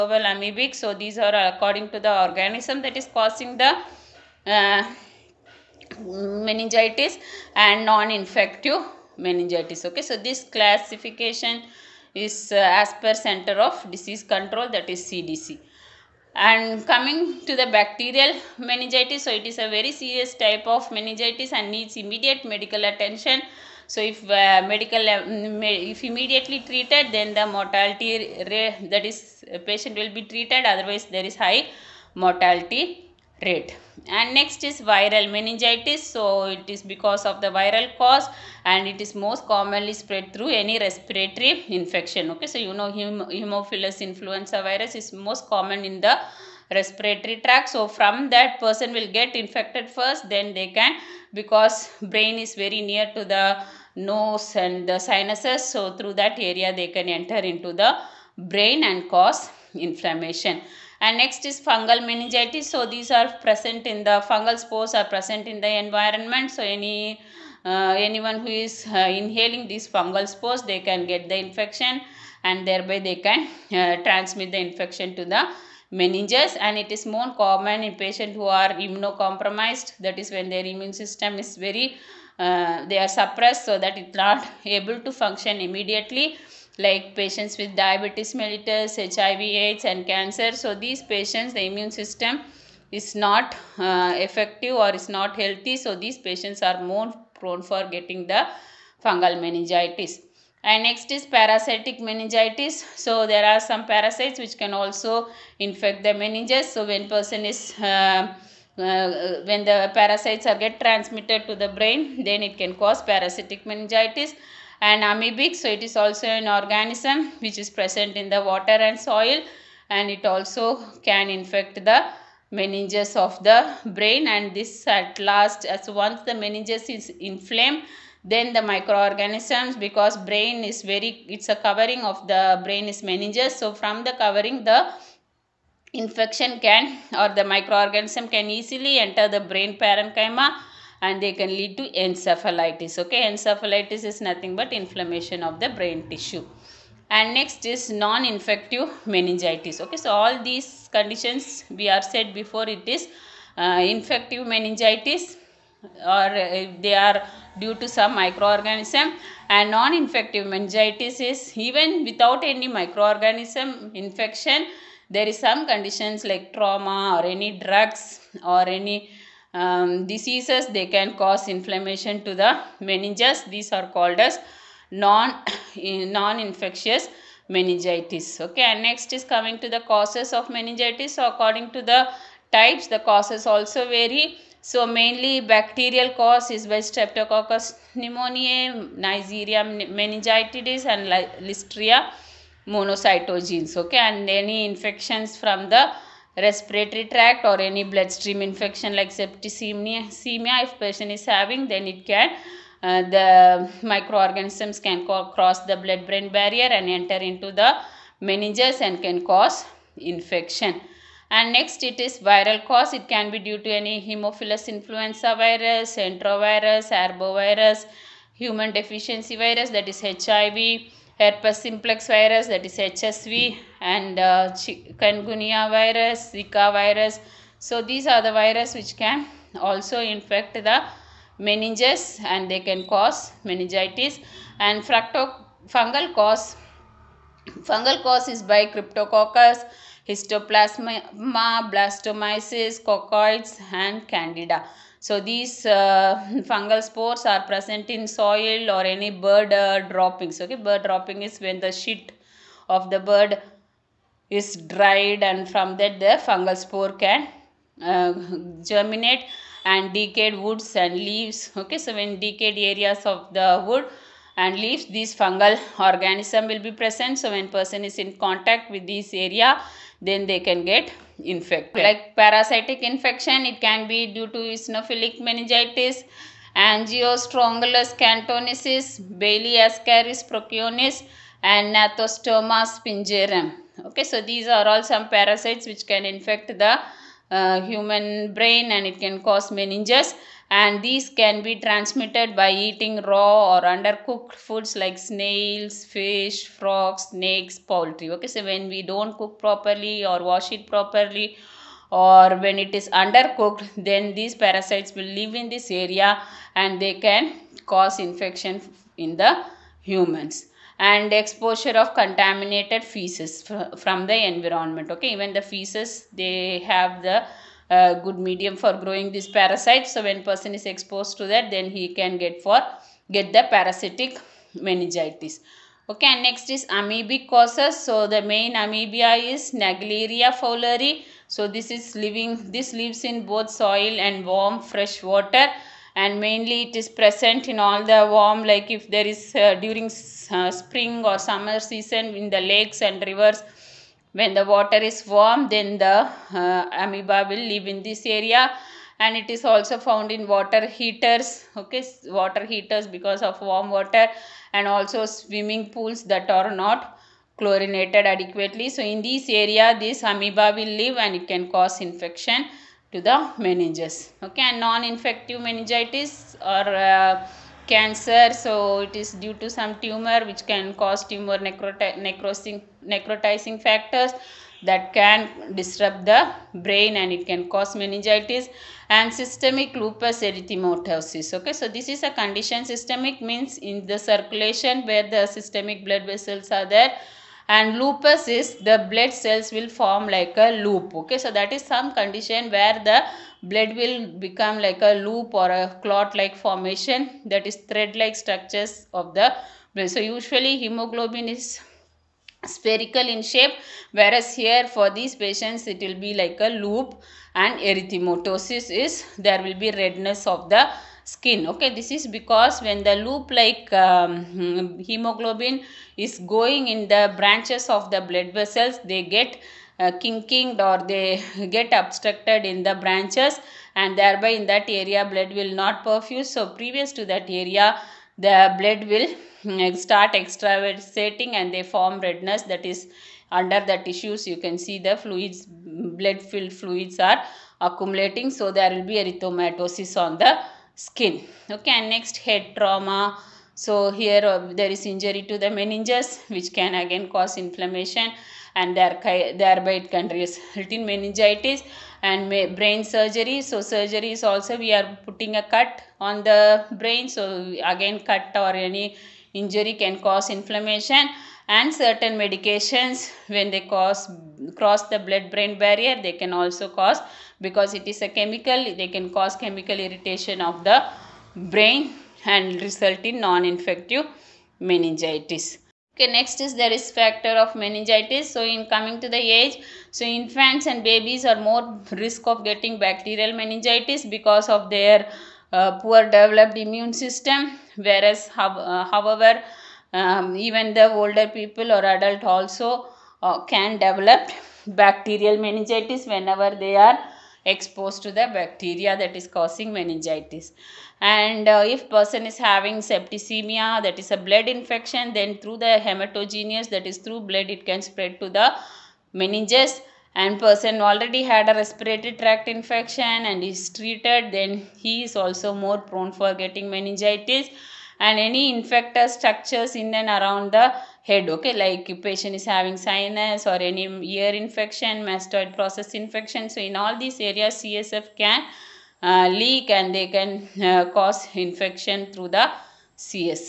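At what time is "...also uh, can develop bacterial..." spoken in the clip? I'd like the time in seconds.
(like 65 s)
492 s.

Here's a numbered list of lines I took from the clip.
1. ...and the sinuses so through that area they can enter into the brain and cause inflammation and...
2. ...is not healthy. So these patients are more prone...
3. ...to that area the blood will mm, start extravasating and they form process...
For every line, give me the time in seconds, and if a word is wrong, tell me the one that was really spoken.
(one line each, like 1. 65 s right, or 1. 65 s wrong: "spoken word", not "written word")
1. 54 s right
2. 94 s right
3. 426 s wrong: "redness", not "process".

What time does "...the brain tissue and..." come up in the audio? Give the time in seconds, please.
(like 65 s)
145 s.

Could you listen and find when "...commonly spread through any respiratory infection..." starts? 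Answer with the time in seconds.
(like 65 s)
39 s.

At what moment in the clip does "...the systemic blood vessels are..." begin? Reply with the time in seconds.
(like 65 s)
385 s.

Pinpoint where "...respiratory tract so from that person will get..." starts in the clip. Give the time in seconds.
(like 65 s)
46 s.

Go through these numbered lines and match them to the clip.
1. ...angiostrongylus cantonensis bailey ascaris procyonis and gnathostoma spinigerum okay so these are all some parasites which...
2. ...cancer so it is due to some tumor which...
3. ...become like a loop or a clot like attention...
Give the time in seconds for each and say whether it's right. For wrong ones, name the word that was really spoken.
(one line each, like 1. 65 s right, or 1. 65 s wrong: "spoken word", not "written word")
1. 276 s right
2. 367 s right
3. 394 s wrong: "formation", not "attention".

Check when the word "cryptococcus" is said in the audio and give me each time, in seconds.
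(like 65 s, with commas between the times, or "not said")
238 s.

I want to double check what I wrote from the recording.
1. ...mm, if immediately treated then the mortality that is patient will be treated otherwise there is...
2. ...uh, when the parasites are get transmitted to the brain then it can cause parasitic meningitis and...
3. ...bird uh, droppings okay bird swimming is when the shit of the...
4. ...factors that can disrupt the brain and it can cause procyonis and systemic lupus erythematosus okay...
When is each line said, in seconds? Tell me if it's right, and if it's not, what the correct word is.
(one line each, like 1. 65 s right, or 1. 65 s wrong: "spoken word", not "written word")
1. 24 s right
2. 108 s right
3. 249 s wrong: "dropping", not "swimming"
4. 373 s wrong: "meningitis", not "procyonis".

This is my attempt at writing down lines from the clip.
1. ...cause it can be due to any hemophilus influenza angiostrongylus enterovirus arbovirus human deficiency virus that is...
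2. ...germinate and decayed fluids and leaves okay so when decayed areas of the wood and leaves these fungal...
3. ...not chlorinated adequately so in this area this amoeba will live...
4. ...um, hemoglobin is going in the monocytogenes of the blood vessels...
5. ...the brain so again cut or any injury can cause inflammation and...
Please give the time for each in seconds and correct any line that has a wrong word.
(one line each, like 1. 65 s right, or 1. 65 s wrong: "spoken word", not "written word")
1. 212 s wrong: "virus", not "angiostrongylus"
2. 258 s wrong: "woods", not "fluids"
3. 356 s right
4. 413 s wrong: "branches", not "monocytogenes"
5. 456 s right.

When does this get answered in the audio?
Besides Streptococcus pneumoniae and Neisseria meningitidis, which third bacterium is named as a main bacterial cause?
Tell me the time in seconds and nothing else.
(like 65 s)
191 s.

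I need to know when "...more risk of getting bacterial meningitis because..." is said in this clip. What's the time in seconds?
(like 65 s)
481 s.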